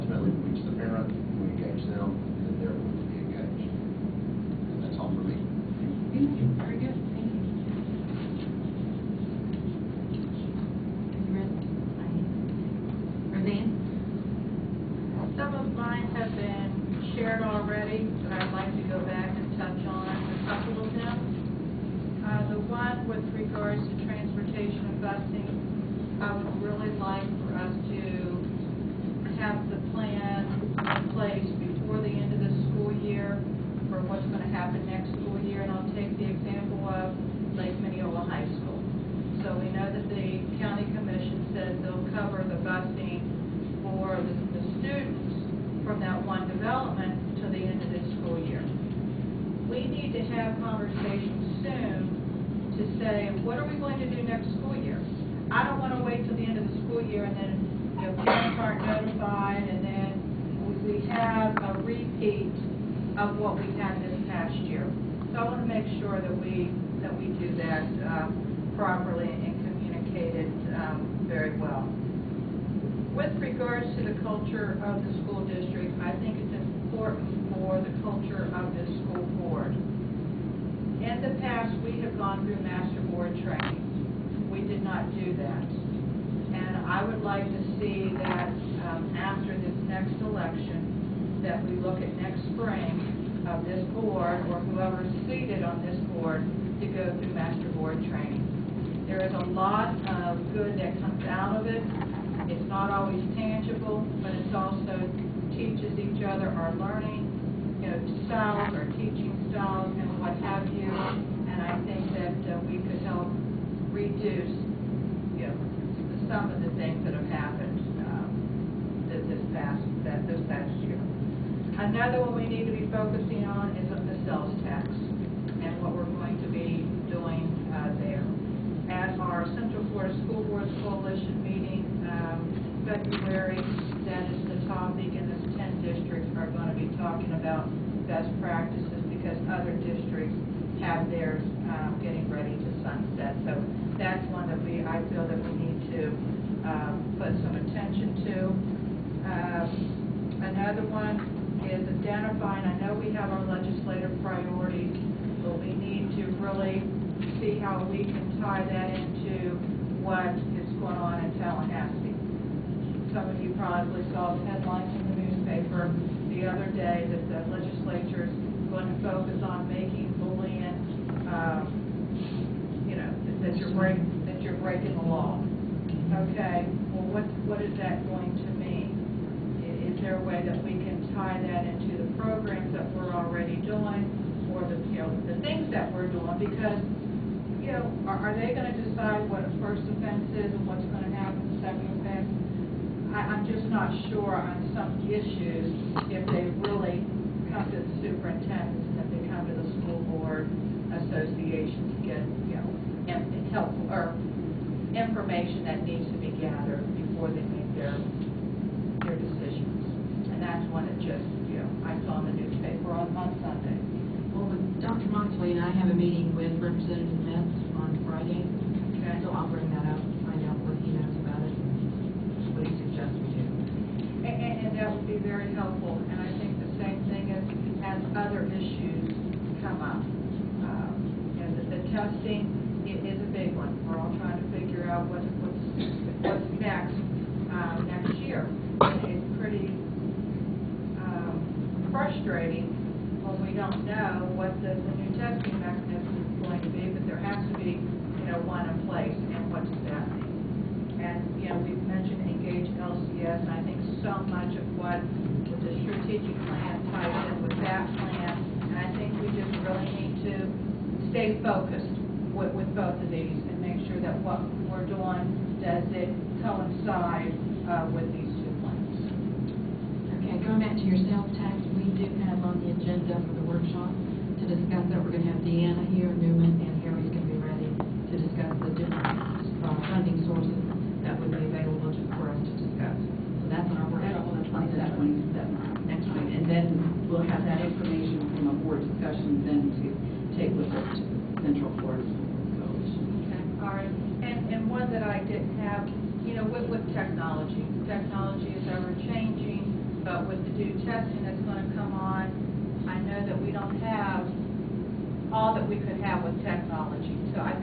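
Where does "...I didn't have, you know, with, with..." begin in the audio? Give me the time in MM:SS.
04:55.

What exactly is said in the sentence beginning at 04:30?
Okay, going back to your sales tax, we do have on the agenda for the workshop to discuss that.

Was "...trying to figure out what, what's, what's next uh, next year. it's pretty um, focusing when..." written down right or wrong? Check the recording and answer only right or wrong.
wrong.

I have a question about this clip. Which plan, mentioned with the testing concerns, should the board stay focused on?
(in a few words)
Engage LCS.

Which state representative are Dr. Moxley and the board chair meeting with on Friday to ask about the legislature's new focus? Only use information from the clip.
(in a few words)
Representative Metz.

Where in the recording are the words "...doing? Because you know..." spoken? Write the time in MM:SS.
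03:06.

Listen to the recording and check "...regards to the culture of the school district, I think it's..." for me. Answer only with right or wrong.
right.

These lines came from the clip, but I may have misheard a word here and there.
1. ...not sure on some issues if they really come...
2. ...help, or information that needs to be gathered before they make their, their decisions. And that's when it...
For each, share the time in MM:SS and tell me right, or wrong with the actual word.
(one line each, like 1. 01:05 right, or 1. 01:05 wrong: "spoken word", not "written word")
1. 03:13 right
2. 03:23 right.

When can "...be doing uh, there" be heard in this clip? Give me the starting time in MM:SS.
02:06.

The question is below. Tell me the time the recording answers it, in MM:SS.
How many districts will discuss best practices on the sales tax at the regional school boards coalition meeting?
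02:15.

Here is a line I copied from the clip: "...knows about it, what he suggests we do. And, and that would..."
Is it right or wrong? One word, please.
right.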